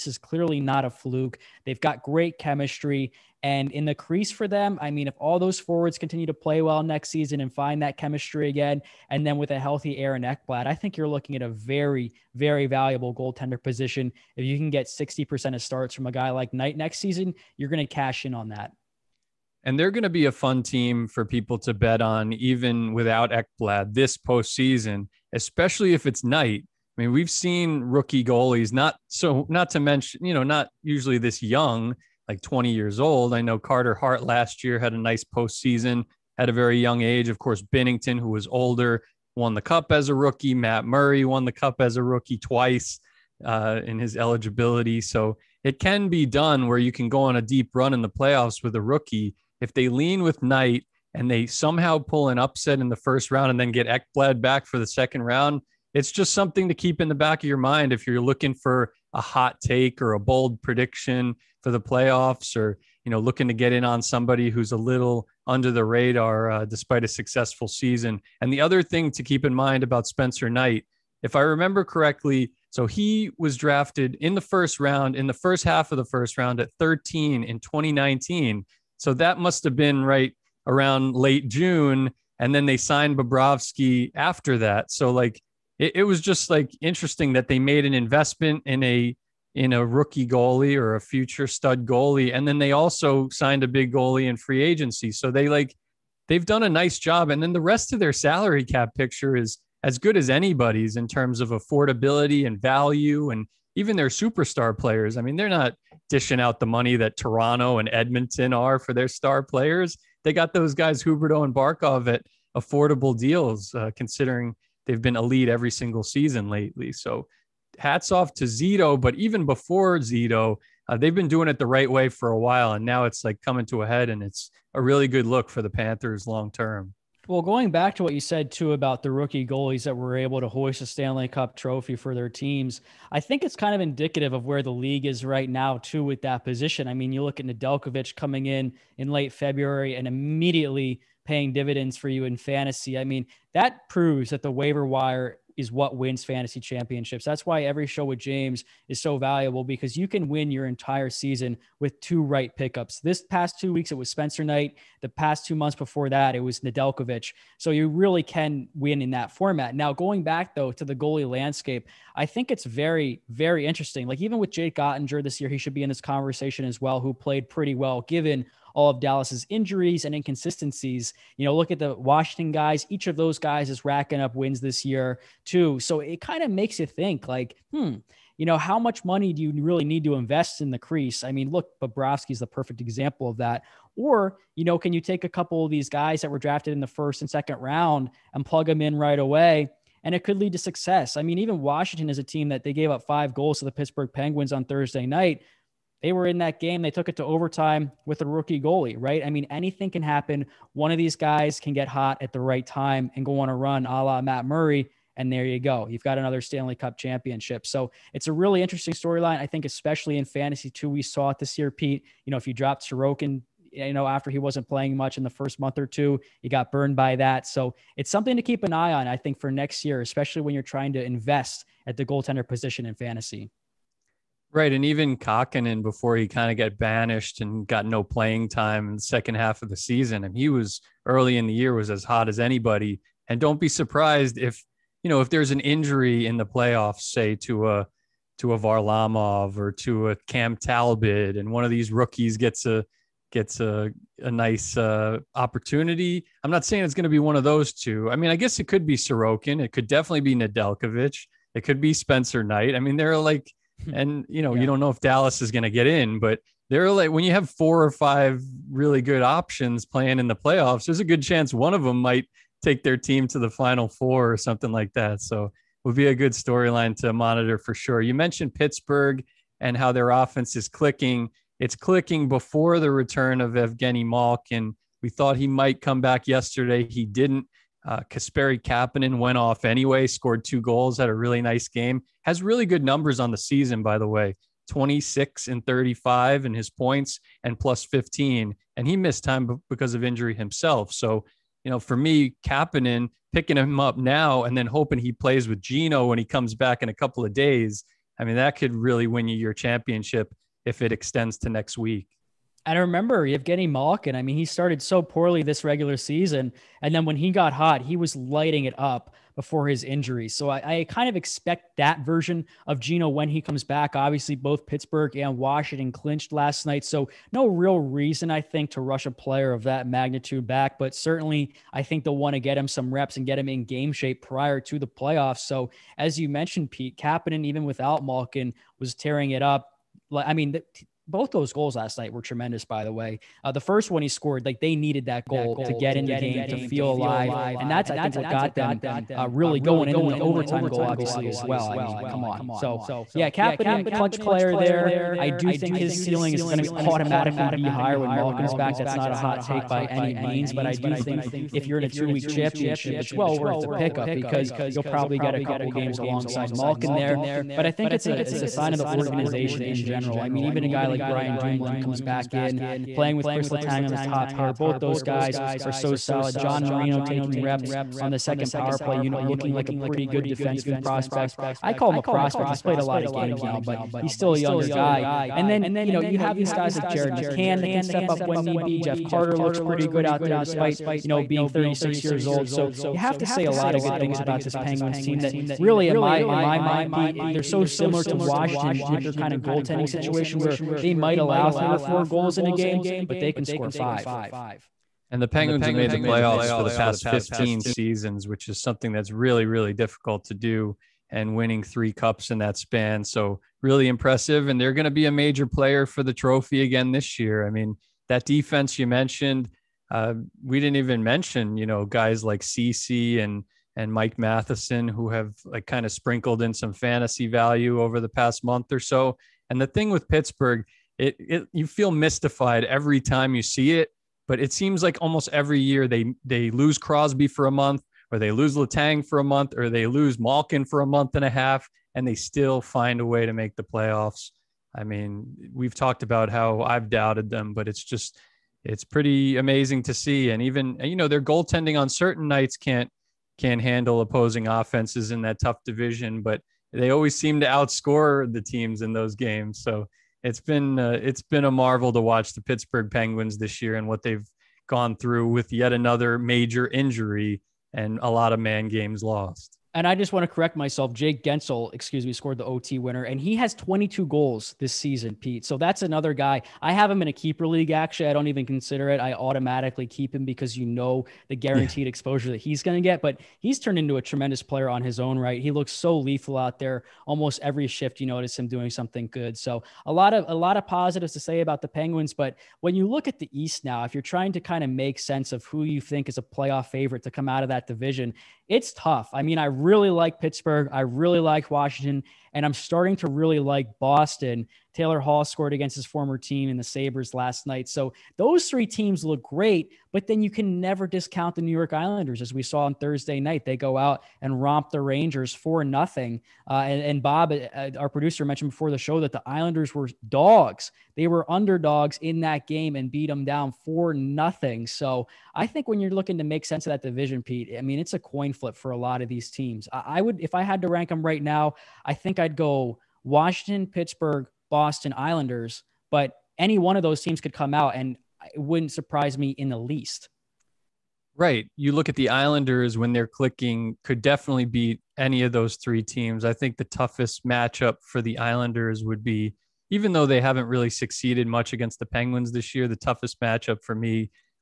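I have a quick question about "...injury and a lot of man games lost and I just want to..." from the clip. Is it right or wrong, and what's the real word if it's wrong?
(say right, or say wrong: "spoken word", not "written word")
right.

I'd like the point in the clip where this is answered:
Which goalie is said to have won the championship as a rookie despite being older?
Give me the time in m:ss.
0:37.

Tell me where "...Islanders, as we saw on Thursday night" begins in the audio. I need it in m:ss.
8:21.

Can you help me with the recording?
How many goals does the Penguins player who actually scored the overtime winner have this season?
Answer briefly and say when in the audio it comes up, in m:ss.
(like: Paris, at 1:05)
22, at 7:43.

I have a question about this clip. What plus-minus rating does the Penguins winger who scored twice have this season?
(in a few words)
plus 15.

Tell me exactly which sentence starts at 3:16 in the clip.
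They took it to overtime with a rookie goalie, right?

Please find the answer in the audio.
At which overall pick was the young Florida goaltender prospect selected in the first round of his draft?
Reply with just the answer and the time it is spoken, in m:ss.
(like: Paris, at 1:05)
13, at 1:16.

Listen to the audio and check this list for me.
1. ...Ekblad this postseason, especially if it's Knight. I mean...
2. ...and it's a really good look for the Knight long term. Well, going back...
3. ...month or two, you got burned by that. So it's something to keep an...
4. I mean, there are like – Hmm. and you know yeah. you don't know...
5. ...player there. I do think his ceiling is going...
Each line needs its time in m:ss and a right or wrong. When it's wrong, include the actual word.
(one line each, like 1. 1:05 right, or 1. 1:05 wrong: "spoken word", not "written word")
1. 0:23 right
2. 2:04 wrong: "Panthers", not "Knight"
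3. 3:35 right
4. 4:12 right
5. 5:44 right.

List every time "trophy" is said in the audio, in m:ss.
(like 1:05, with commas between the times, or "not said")
2:11, 6:46.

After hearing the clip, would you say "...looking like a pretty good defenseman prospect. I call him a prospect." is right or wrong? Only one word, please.
right.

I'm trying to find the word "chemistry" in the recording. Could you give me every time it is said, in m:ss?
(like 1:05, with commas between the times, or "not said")
0:02, 0:07.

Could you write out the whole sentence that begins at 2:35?
The past two months before that, it was Nedeljkovic.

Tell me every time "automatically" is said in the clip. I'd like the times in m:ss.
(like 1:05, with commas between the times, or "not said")
5:46, 7:49.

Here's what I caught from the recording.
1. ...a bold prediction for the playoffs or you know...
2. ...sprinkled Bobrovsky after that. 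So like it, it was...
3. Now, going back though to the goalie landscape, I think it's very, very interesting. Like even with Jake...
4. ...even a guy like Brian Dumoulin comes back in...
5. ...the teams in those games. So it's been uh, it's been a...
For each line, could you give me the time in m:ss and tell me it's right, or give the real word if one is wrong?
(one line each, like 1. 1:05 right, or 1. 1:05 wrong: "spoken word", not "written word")
1. 1:00 right
2. 1:22 wrong: "signed", not "sprinkled"
3. 2:39 right
4. 6:00 right
5. 7:28 right.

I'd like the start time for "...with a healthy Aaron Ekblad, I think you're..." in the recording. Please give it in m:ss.
0:09.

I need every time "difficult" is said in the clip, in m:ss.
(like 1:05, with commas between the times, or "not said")
6:39.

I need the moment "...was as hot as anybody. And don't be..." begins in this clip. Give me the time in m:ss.
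3:51.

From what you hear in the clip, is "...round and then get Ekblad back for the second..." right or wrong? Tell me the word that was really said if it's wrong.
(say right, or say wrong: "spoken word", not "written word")
right.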